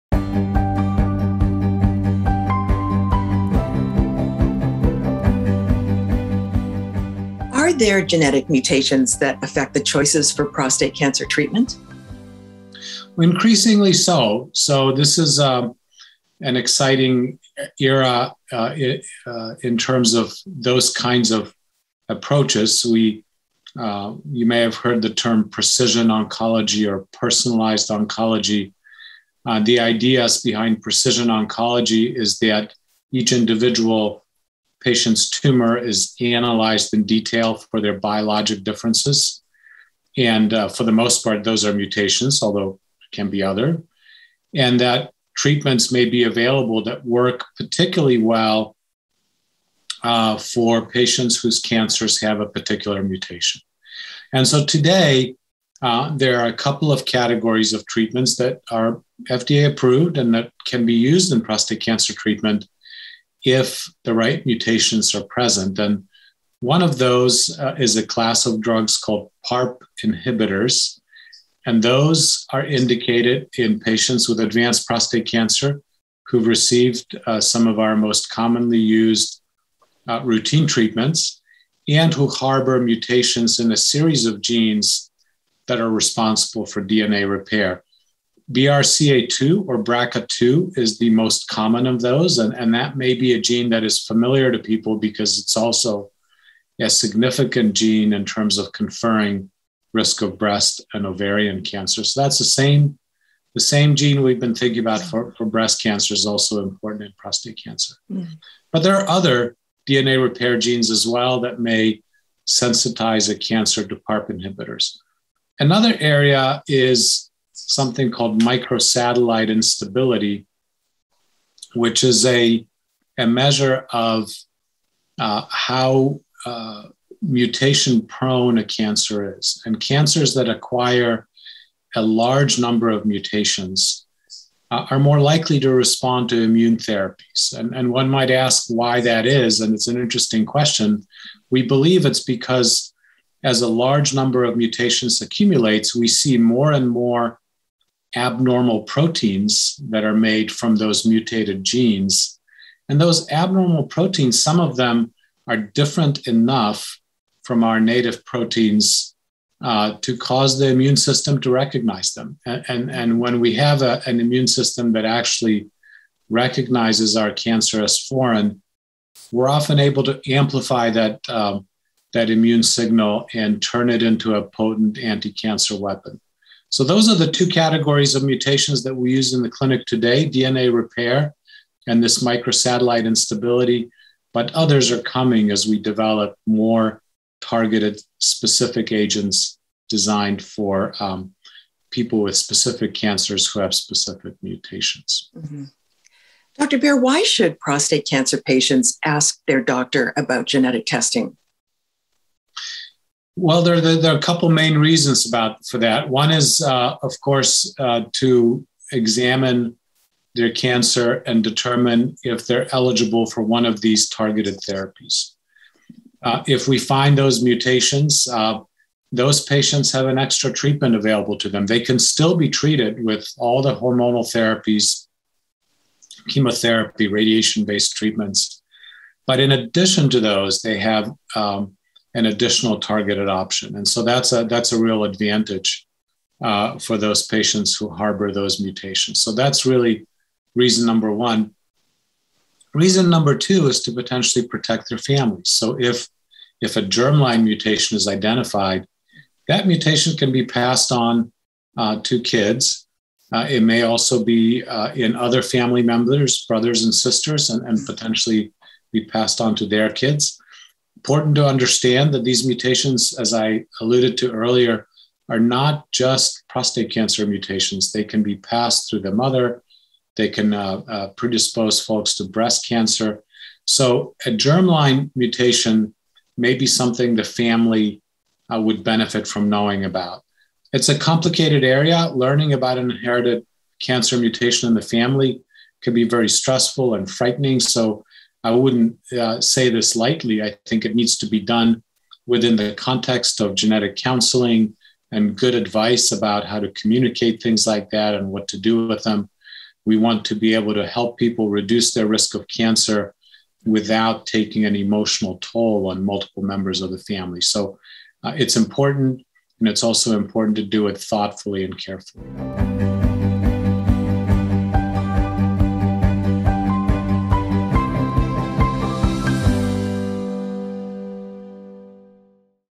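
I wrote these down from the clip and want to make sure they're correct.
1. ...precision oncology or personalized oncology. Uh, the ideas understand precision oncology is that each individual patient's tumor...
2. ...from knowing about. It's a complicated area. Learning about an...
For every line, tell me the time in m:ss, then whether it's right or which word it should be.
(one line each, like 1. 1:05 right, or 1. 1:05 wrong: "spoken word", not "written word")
1. 0:25 wrong: "behind", not "understand"
2. 4:39 right.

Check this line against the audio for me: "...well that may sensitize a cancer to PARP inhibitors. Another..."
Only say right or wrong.
right.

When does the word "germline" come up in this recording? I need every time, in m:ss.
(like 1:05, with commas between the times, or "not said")
4:06, 4:34.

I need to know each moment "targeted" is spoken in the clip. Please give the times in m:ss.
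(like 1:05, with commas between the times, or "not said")
3:07, 3:34, 3:52.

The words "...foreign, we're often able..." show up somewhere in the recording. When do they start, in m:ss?
2:47.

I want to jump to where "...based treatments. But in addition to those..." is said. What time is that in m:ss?
3:47.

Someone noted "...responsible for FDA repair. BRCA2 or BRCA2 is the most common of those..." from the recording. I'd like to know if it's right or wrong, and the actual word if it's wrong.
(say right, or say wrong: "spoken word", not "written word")
wrong: "DNA", not "FDA".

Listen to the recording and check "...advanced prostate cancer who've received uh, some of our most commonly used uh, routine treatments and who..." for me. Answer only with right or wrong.
right.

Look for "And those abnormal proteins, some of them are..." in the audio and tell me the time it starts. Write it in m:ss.
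2:32.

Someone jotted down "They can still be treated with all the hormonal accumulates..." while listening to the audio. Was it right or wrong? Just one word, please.
wrong.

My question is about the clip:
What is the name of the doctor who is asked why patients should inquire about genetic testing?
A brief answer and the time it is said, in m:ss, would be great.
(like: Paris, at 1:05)
Dr. Beer, at 3:16.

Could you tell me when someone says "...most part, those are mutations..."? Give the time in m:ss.
0:40.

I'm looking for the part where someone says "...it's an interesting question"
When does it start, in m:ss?
2:19.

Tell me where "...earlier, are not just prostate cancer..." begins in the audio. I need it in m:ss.
4:24.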